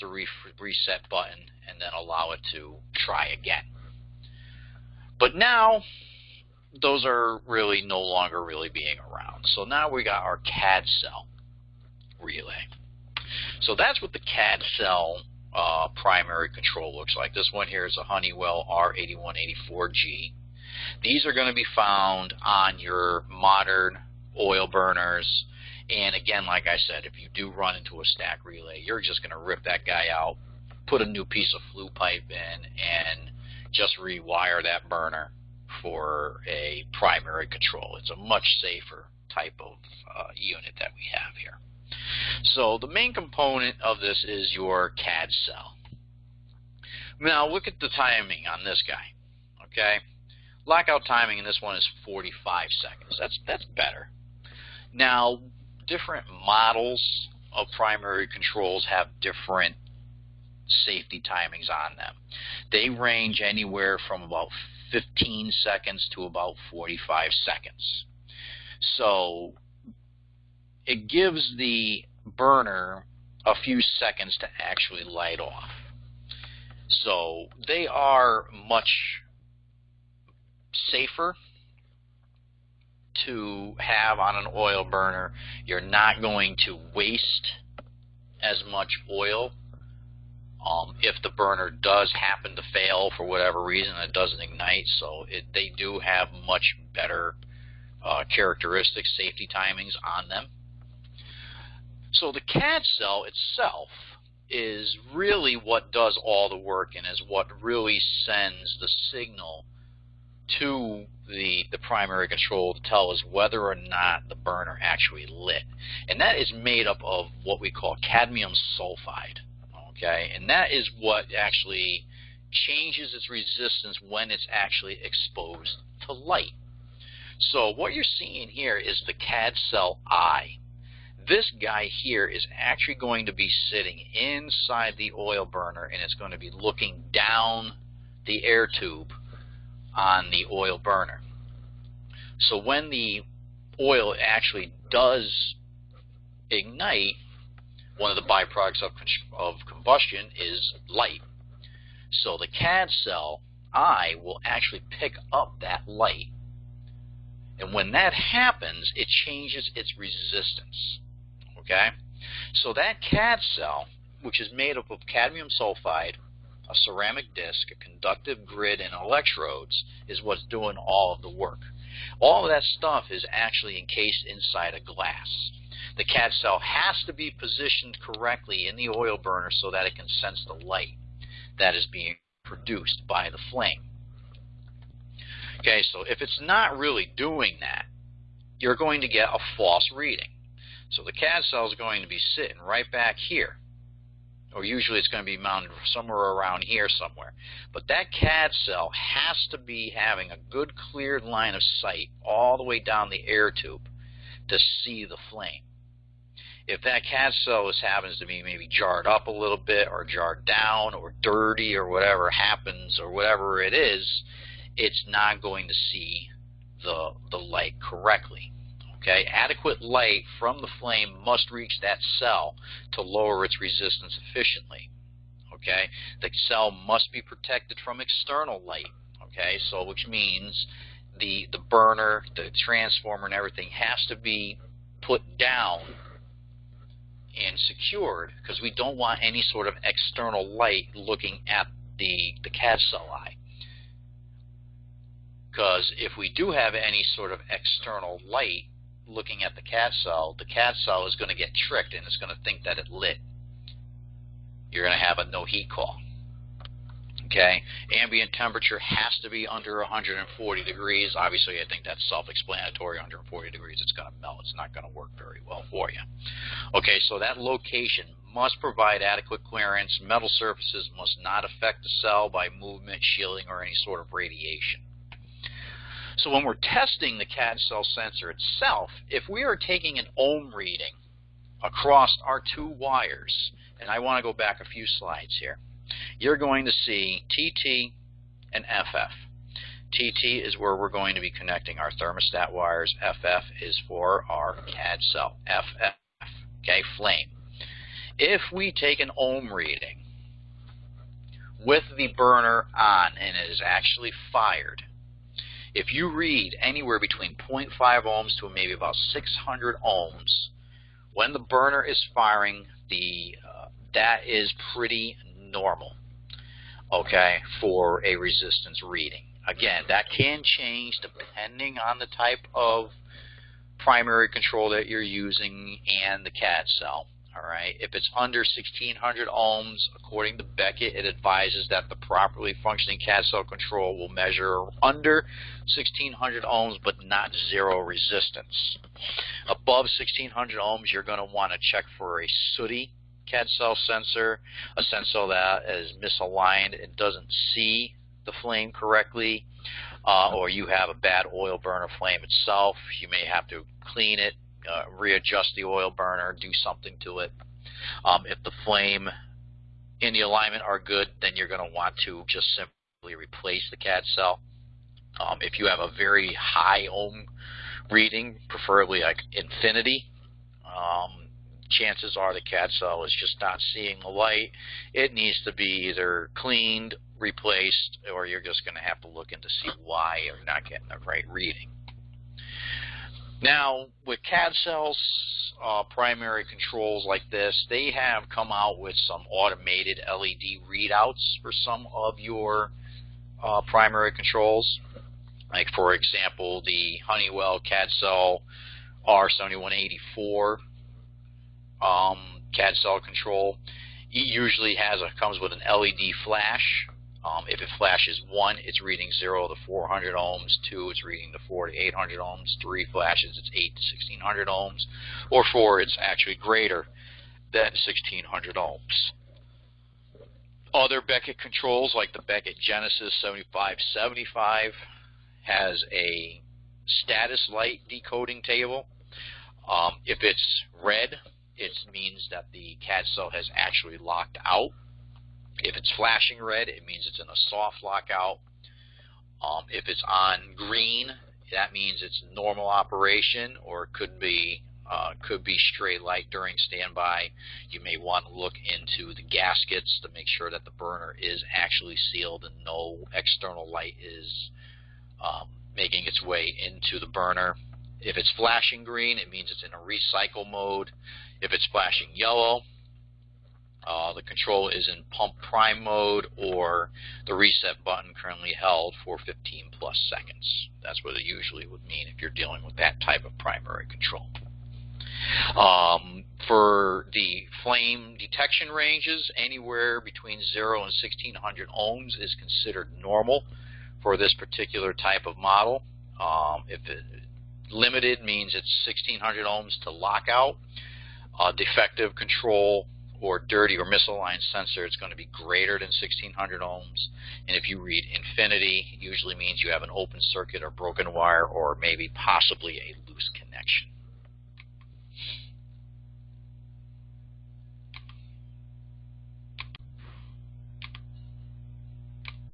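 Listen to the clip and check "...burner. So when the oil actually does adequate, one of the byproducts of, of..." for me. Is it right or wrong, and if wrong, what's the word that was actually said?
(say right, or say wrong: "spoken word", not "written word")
wrong: "ignite", not "adequate".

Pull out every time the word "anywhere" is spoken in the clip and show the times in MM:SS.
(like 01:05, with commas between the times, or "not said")
01:03, 05:06, 07:59.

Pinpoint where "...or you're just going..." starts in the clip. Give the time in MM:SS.
06:18.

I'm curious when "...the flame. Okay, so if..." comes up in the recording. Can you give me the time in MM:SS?
03:03.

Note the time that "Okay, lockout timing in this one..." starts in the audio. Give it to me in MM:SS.
00:49.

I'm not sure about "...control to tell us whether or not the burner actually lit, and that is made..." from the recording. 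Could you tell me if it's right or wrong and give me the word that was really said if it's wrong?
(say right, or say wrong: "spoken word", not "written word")
right.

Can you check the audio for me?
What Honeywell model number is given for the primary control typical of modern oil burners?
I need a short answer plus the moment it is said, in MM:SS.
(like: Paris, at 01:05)
R8184G, at 00:18.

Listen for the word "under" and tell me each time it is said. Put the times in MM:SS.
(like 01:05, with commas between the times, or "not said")
04:19, 05:28, 05:34.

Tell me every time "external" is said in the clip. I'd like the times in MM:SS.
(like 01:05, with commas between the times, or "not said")
03:48, 03:59, 04:07, 07:33.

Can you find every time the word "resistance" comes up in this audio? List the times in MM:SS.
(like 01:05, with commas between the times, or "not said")
02:03, 02:39, 03:43, 05:18, 05:37.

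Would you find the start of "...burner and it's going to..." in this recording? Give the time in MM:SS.
02:15.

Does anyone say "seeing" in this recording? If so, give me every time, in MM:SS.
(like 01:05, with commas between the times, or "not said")
02:08, 06:13.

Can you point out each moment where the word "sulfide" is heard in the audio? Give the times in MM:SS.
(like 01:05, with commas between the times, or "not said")
01:58, 02:45.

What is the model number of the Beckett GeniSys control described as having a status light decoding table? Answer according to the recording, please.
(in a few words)
7575.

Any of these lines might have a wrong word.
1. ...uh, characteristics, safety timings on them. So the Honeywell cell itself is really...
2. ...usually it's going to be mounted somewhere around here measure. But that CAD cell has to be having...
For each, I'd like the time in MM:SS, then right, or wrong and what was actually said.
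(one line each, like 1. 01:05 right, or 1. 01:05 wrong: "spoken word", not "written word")
1. 01:38 wrong: "CAD", not "Honeywell"
2. 03:14 wrong: "somewhere", not "measure".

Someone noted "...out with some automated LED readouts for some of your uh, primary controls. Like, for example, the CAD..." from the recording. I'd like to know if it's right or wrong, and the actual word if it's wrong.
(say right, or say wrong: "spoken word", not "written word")
wrong: "Honeywell", not "CAD".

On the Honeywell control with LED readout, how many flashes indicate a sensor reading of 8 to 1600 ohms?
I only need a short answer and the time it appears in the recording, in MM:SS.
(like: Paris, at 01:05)
3, at 06:52.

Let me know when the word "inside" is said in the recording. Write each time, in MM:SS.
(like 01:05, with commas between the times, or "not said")
02:14, 02:54.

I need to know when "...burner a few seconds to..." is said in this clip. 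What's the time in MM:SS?
01:12.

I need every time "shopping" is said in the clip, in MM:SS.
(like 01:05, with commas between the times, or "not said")
not said.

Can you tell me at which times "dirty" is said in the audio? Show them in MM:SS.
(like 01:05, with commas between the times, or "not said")
03:31, 08:13.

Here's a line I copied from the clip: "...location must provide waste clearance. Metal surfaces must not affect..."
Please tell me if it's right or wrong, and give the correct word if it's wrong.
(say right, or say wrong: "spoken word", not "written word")
wrong: "adequate", not "waste".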